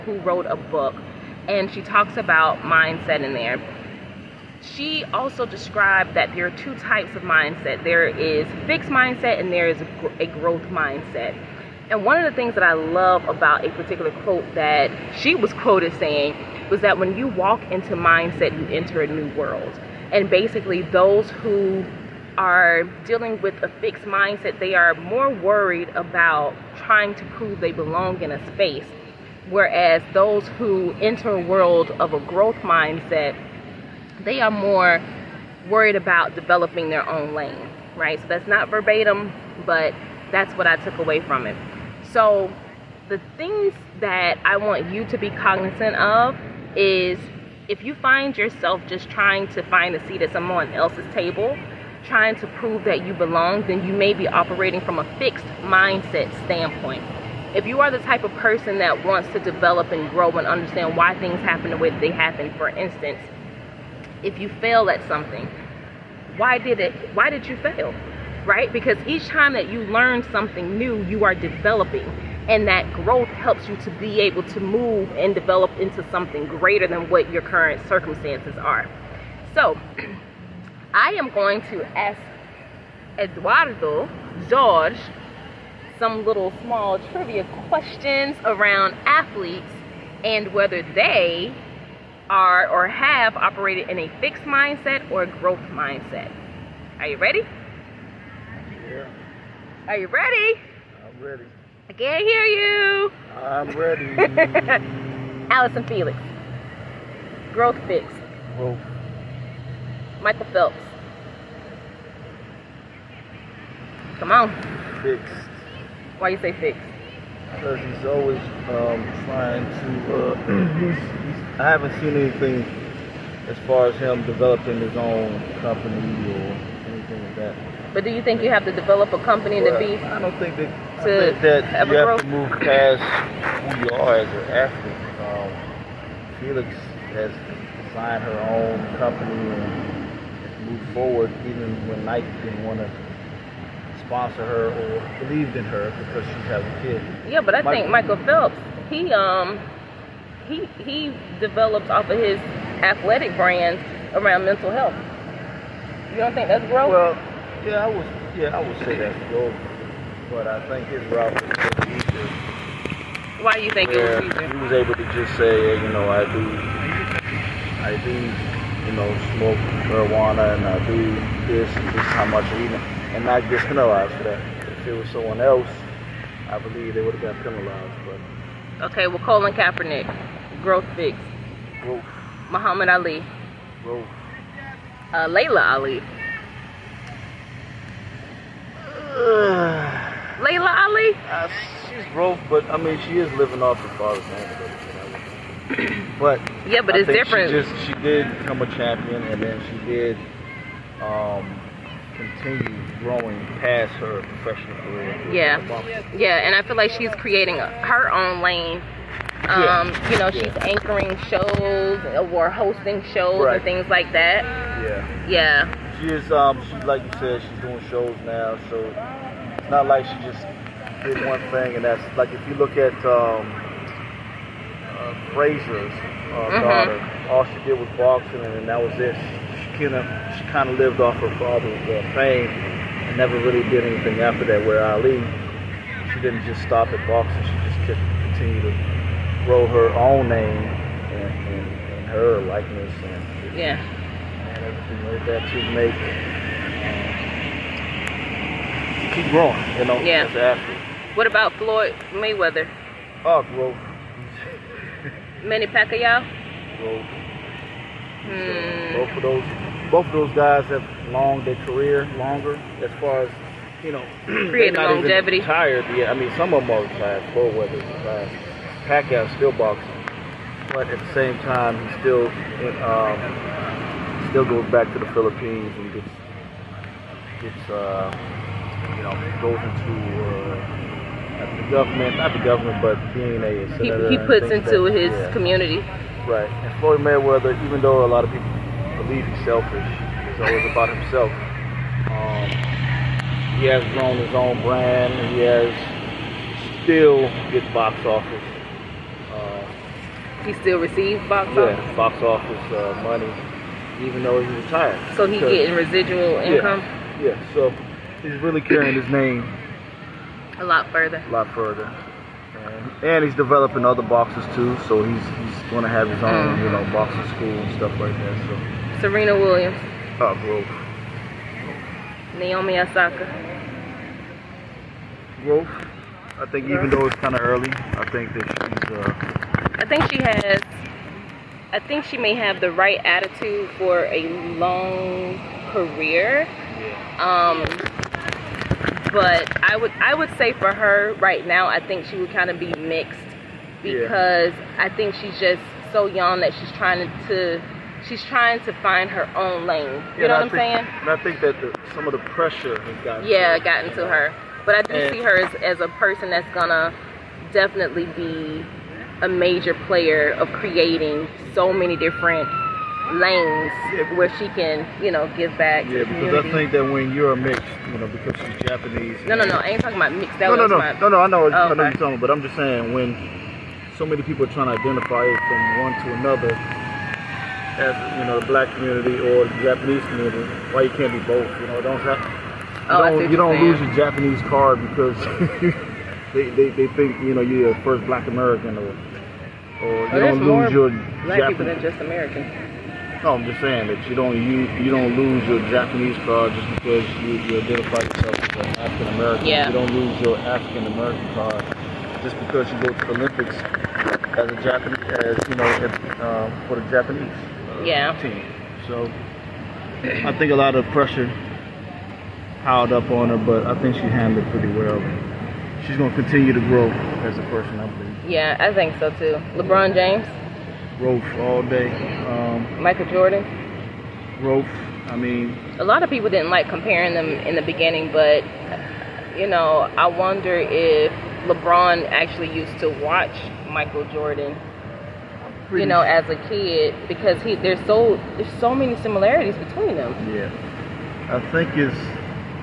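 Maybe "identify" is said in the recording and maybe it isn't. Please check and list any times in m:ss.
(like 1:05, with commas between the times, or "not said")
6:14, 6:37.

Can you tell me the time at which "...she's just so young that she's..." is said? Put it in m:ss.
5:45.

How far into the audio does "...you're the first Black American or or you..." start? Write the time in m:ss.
6:27.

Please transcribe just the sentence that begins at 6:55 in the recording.
She's going to continue to grow as a person, I believe.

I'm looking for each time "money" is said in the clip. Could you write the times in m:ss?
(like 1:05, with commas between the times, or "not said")
5:03.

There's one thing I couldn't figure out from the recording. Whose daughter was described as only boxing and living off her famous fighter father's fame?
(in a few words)
Frazier.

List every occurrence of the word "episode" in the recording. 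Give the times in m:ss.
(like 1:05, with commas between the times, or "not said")
not said.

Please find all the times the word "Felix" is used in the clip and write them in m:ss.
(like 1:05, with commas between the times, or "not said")
1:45, 2:16.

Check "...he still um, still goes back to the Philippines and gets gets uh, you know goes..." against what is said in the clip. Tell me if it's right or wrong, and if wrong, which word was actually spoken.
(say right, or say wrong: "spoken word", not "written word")
right.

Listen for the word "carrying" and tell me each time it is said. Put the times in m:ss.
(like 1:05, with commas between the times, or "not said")
5:08.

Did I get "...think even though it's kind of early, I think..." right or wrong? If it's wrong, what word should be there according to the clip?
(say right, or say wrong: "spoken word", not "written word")
right.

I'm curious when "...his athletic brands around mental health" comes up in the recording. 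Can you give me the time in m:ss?
2:32.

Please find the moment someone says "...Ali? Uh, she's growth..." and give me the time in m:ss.
3:10.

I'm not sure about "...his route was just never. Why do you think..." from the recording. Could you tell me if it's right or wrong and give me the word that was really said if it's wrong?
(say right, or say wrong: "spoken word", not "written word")
wrong: "easier", not "never".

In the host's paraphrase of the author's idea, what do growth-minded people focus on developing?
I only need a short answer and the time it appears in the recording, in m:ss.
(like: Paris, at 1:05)
Their own lane, at 0:36.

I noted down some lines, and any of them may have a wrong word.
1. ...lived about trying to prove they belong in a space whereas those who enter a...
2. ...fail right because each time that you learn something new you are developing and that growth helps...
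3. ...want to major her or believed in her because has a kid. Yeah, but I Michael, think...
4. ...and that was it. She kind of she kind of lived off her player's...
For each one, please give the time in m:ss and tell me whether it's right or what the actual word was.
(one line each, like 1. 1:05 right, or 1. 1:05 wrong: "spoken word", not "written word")
1. 0:25 wrong: "worried", not "lived"
2. 1:07 right
3. 2:22 wrong: "sponsor", not "major"
4. 3:48 wrong: "father", not "player".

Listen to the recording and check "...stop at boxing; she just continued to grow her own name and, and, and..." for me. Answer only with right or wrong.
right.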